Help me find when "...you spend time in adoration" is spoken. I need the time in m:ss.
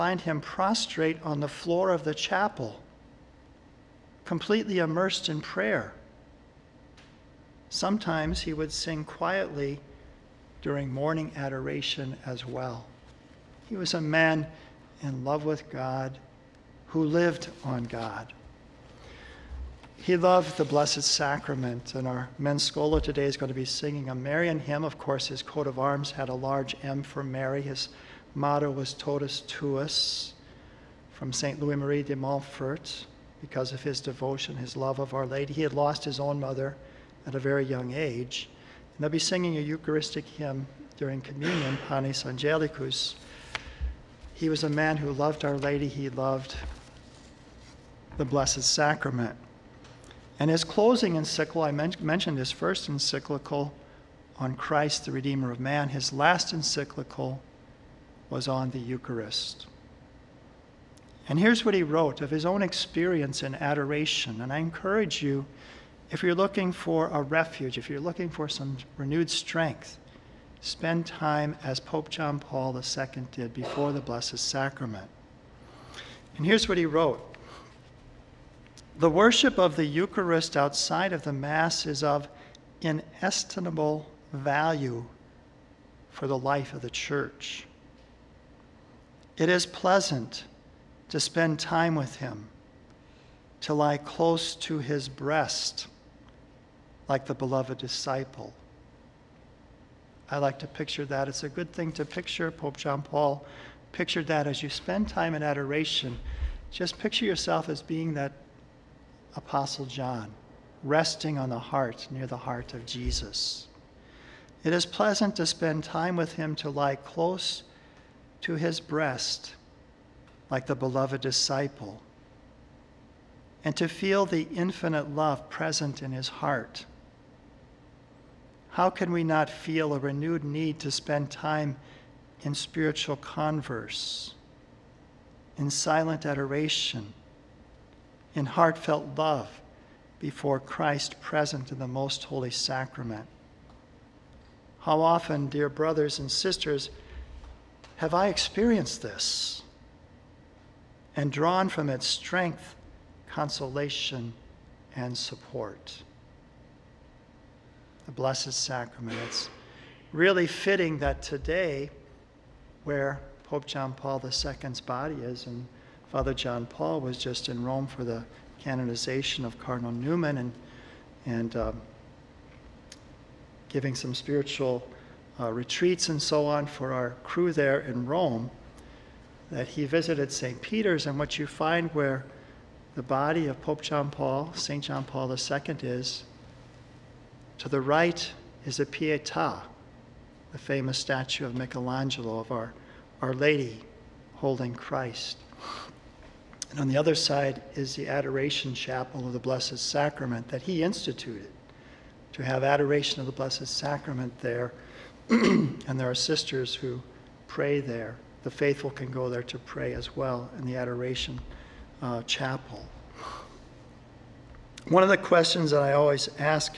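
1:44.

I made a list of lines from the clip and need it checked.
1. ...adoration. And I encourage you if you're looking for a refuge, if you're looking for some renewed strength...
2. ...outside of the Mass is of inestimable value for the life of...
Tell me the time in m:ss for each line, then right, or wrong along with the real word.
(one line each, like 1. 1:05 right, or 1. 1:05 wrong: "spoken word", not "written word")
1. 1:03 right
2. 1:20 right.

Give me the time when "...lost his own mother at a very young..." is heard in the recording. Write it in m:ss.
0:35.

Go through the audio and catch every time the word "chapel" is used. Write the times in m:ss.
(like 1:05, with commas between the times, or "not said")
0:02, 3:18, 3:32.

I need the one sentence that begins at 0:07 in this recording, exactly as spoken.
Sometimes he would sing quietly during morning adoration as well.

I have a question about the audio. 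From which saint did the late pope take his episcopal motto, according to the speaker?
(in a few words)
St. Louis Marie de Montfort.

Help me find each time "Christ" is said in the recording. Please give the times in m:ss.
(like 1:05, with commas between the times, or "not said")
0:54, 2:20, 3:14.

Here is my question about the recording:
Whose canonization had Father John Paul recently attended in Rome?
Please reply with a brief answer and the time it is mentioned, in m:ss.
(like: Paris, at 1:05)
Cardinal Newman, at 2:49.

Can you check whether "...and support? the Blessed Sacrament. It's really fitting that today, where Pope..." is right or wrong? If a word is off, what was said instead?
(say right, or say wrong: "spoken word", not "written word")
right.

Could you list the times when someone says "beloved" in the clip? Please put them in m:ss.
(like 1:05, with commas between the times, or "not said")
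1:37, 2:00.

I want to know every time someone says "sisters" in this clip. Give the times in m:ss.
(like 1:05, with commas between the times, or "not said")
2:26, 3:26.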